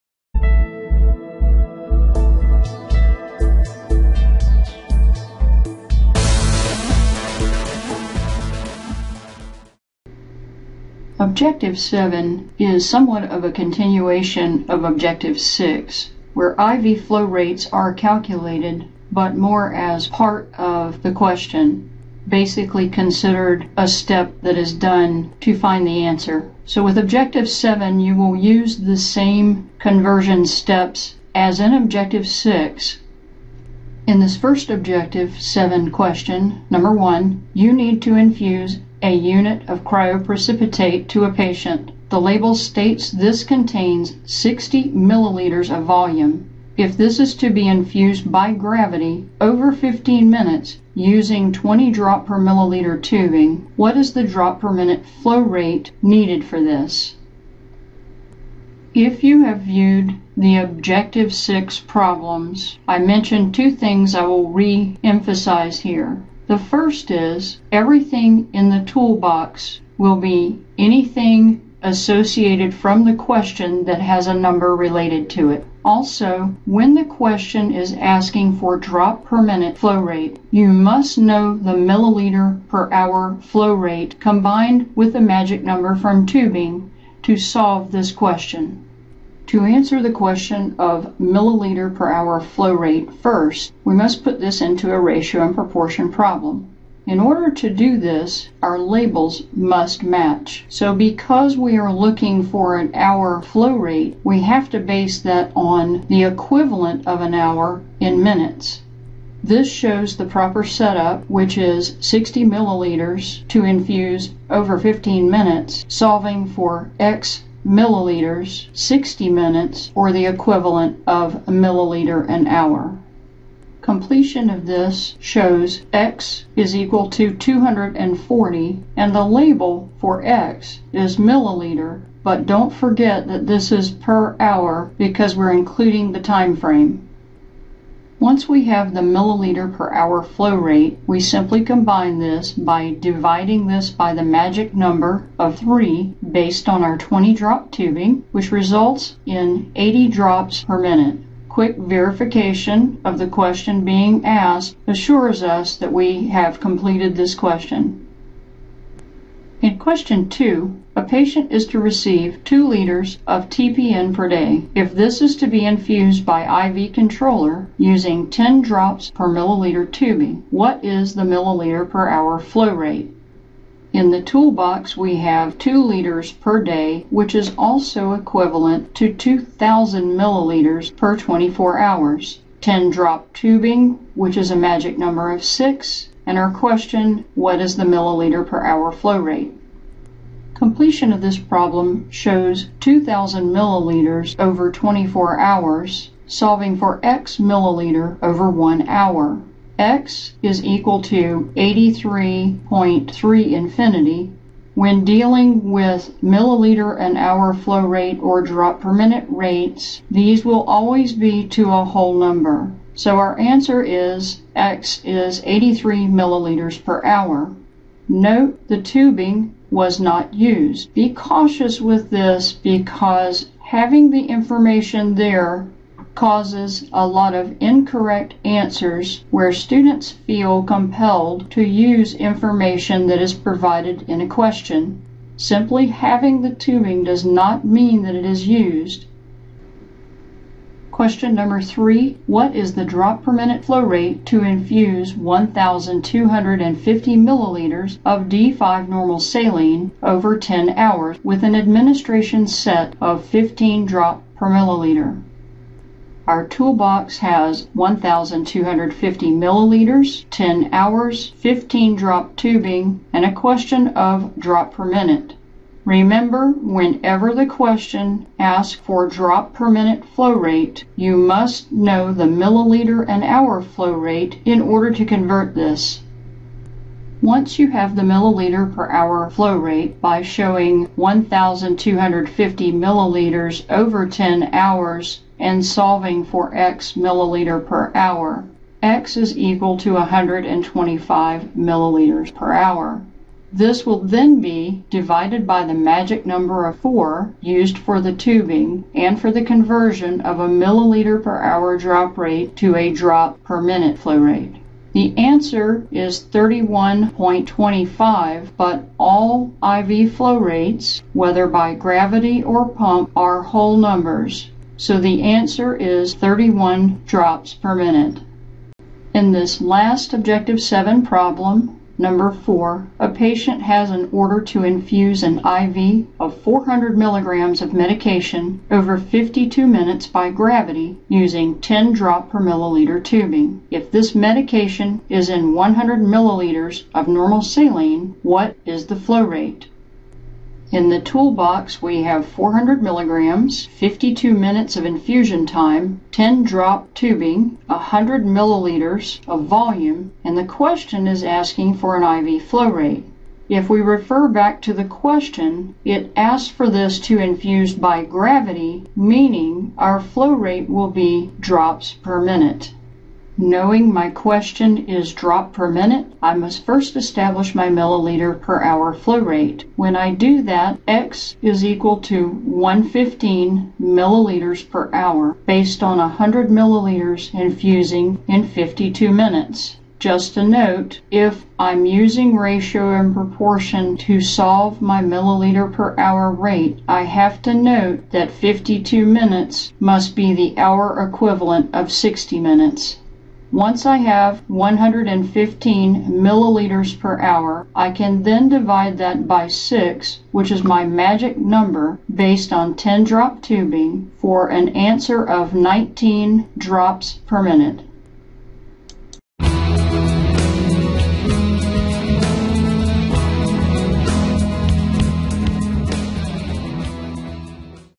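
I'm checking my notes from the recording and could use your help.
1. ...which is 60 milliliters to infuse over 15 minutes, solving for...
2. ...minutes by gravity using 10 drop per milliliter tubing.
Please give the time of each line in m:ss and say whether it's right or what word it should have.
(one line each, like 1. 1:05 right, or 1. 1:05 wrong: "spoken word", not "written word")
1. 1:51 right
2. 5:29 right.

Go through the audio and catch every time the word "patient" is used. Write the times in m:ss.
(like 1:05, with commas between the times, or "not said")
0:41, 2:41, 5:23.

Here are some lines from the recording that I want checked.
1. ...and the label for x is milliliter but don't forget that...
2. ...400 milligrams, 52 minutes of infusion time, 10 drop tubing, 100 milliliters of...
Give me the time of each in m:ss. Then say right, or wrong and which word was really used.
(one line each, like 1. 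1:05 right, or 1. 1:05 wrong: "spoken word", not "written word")
1. 2:08 right
2. 5:42 right.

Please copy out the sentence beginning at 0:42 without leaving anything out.
The label states this contains 60 milliliters of volume.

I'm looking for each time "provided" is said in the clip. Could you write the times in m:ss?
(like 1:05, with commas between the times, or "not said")
3:53.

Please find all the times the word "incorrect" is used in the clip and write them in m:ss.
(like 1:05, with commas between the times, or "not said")
3:47.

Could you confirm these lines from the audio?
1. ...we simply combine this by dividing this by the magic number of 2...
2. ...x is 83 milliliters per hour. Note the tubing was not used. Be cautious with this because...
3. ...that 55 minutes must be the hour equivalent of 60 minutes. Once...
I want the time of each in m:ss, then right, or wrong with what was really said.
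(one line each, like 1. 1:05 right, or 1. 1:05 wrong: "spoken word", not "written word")
1. 2:21 wrong: "3", not "2"
2. 3:34 right
3. 6:28 wrong: "52", not "55".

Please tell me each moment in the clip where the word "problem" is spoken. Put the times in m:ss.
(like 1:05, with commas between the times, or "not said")
1:01, 1:36, 3:11, 5:21.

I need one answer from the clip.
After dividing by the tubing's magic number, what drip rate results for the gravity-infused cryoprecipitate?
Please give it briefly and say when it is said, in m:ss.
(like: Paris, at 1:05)
80 drops per minute, at 2:29.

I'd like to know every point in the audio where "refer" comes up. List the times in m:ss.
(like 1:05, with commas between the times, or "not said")
5:53.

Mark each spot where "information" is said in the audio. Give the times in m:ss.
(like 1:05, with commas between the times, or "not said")
3:44, 3:52.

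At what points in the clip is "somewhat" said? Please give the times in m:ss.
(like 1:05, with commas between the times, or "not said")
0:12.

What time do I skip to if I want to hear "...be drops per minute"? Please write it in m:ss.
6:00.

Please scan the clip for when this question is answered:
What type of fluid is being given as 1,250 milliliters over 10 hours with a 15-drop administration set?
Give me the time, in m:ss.
4:08.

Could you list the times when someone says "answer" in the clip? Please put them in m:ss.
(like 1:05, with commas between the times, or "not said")
0:26, 1:29, 3:33, 3:48, 5:05, 5:15, 6:44.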